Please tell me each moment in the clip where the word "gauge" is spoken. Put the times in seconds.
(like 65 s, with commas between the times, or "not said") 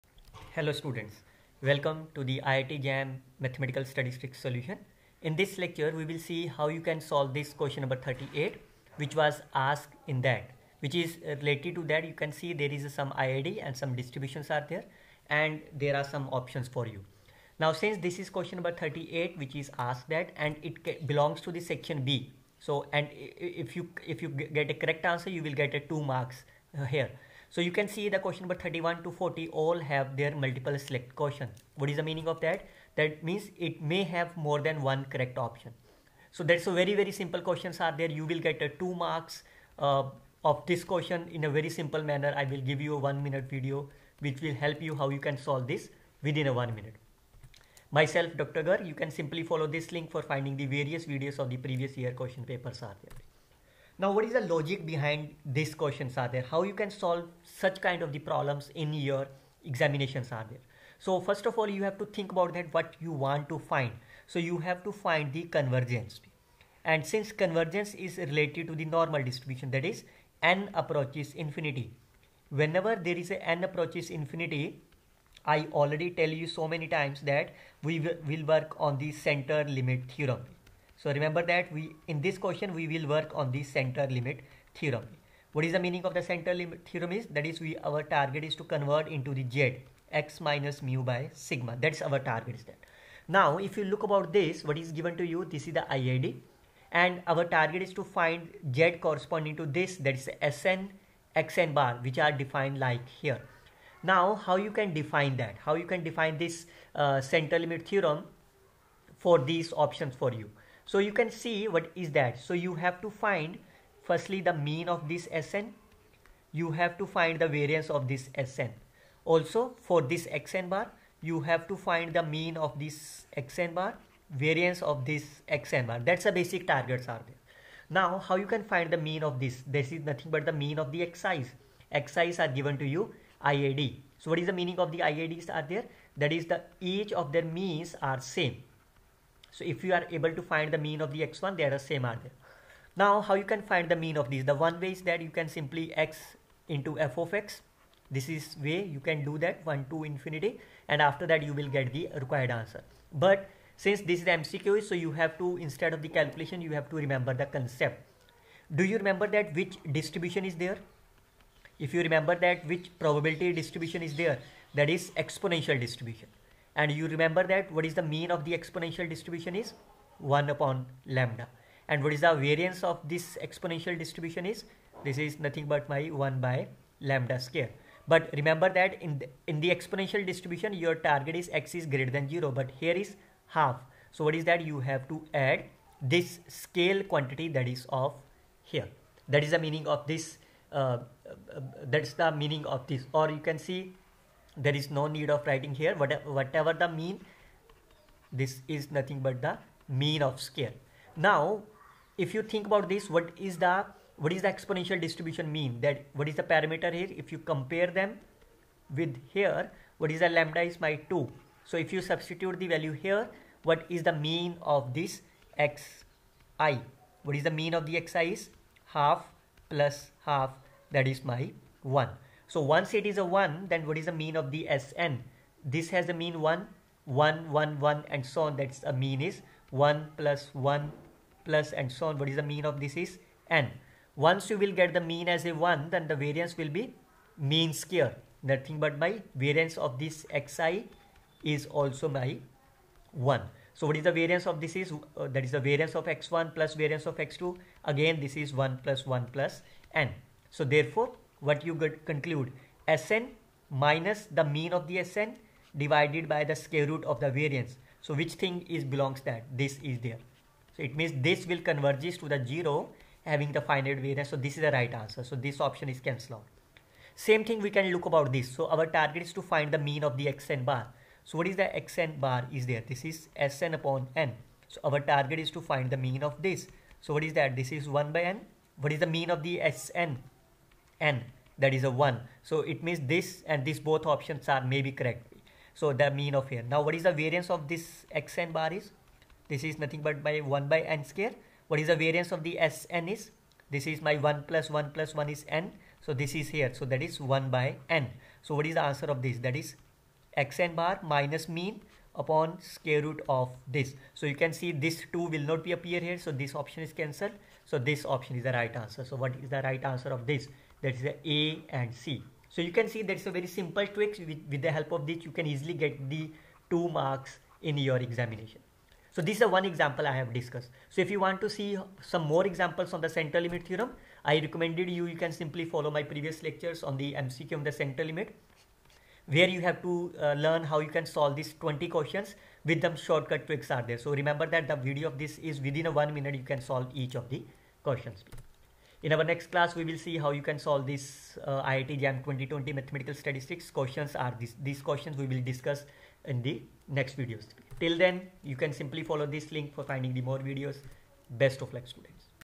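not said.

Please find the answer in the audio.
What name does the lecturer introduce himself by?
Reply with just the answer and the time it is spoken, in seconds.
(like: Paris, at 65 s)
Dr. Garg, at 48 s.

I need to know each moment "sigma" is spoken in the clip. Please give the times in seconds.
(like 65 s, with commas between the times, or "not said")
91 s.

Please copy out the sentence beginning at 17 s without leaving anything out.
Now since this is question number 38 which is asked that and it belongs to the section B.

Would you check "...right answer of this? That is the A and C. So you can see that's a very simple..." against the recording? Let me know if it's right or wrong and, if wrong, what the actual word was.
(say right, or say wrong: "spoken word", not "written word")
right.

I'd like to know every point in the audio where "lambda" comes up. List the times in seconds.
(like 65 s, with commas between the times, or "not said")
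171 s, 177 s, 210 s.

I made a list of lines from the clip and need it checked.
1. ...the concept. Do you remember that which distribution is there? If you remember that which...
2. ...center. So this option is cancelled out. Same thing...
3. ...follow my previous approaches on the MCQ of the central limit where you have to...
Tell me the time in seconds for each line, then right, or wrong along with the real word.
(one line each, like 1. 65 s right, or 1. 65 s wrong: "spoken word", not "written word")
1. 157 s right
2. 264 s wrong: "answer", not "center"
3. 325 s wrong: "lectures", not "approaches".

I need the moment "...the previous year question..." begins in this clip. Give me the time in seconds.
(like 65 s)
51 s.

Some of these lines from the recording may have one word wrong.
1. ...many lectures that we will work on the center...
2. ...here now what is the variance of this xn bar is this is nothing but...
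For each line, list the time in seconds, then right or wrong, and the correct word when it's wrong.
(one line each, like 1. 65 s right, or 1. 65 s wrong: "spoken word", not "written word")
1. 76 s wrong: "times", not "lectures"
2. 286 s right.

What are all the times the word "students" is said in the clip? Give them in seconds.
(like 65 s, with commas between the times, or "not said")
0 s, 351 s.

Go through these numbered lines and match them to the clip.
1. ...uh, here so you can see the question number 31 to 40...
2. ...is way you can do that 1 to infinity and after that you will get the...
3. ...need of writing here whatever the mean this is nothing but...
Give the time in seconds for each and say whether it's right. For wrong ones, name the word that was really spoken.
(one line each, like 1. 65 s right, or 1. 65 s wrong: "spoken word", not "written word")
1. 26 s right
2. 148 s right
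3. 195 s right.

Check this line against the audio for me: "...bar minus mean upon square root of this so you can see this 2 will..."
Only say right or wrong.
right.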